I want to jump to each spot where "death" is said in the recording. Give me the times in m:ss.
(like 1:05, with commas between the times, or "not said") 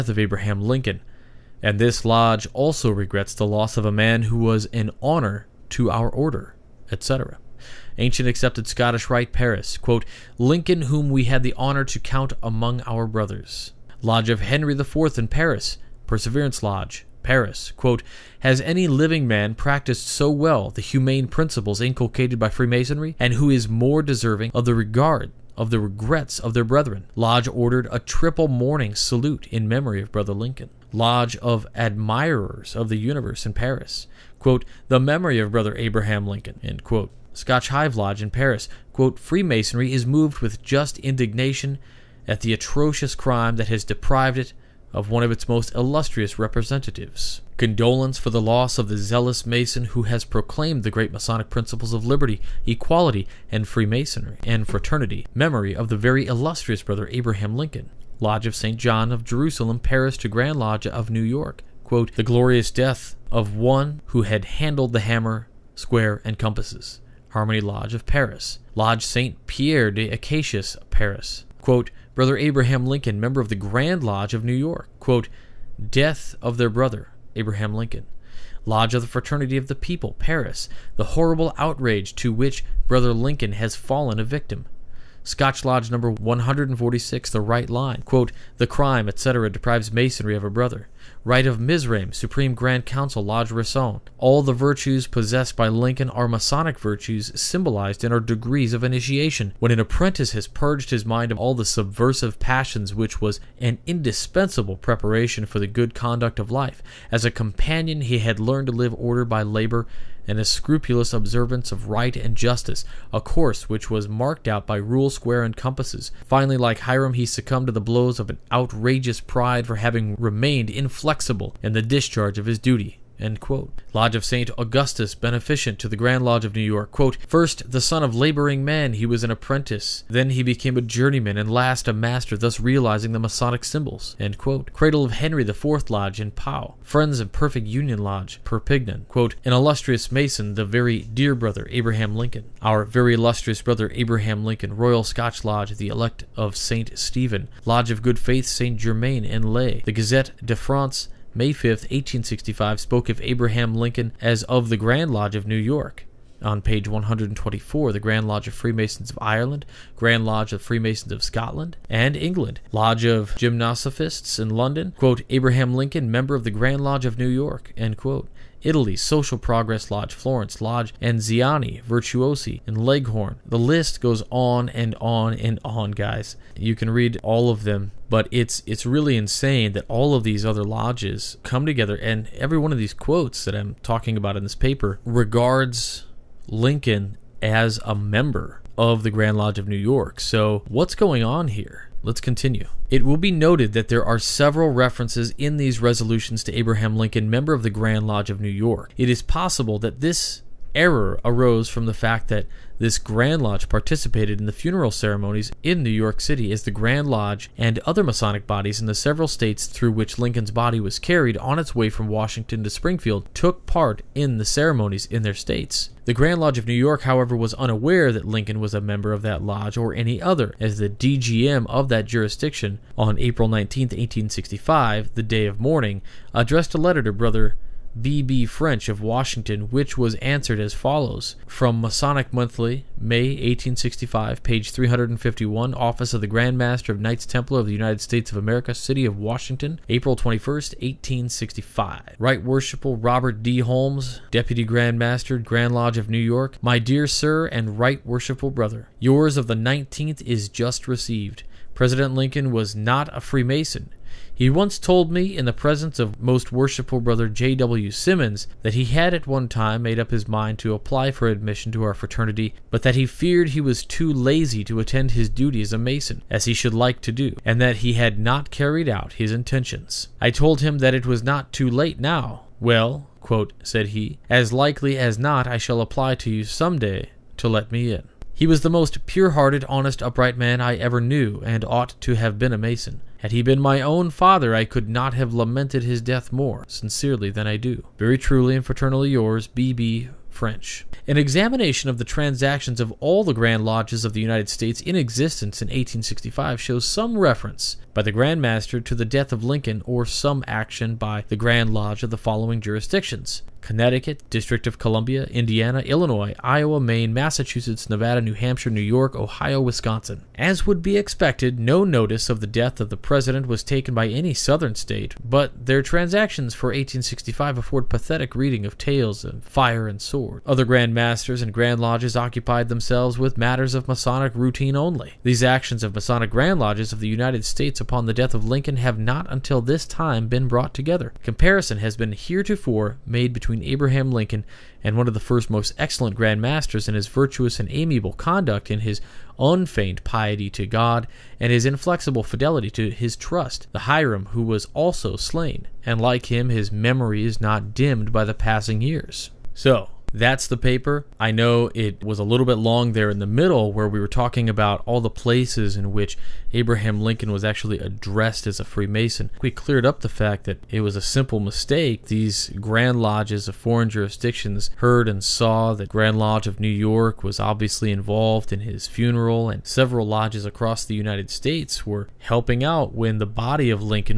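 1:02, 1:15, 4:46, 4:59, 5:12, 5:28.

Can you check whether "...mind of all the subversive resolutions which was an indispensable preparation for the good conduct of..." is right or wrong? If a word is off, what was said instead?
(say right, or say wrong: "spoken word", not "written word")
wrong: "passions", not "resolutions".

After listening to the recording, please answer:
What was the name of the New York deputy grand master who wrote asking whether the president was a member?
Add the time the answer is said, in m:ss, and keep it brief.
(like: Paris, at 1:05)
Robert D. Holmes, at 4:02.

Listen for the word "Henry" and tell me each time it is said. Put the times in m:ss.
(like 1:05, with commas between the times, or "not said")
0:14, 2:15.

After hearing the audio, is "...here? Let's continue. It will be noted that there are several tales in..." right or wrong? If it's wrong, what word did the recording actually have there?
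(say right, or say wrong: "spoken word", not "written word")
wrong: "references", not "tales".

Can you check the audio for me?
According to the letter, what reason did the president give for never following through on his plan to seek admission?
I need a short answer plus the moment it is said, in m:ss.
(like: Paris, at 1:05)
too lazy, at 4:23.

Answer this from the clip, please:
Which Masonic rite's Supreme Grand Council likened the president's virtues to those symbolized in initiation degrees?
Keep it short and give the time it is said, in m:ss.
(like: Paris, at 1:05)
Rite of Mizraim, at 1:31.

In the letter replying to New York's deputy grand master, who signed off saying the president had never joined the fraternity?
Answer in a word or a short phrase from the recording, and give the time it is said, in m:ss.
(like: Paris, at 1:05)
B. B. French, at 4:49.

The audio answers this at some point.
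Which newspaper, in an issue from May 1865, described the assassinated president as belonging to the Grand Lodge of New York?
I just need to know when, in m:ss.
2:29.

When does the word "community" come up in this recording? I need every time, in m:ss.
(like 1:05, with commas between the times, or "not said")
not said.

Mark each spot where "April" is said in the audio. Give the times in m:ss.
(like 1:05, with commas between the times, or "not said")
3:43, 3:59.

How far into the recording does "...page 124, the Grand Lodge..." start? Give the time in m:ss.
2:36.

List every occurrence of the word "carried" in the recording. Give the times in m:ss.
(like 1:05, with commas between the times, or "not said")
3:30, 4:28.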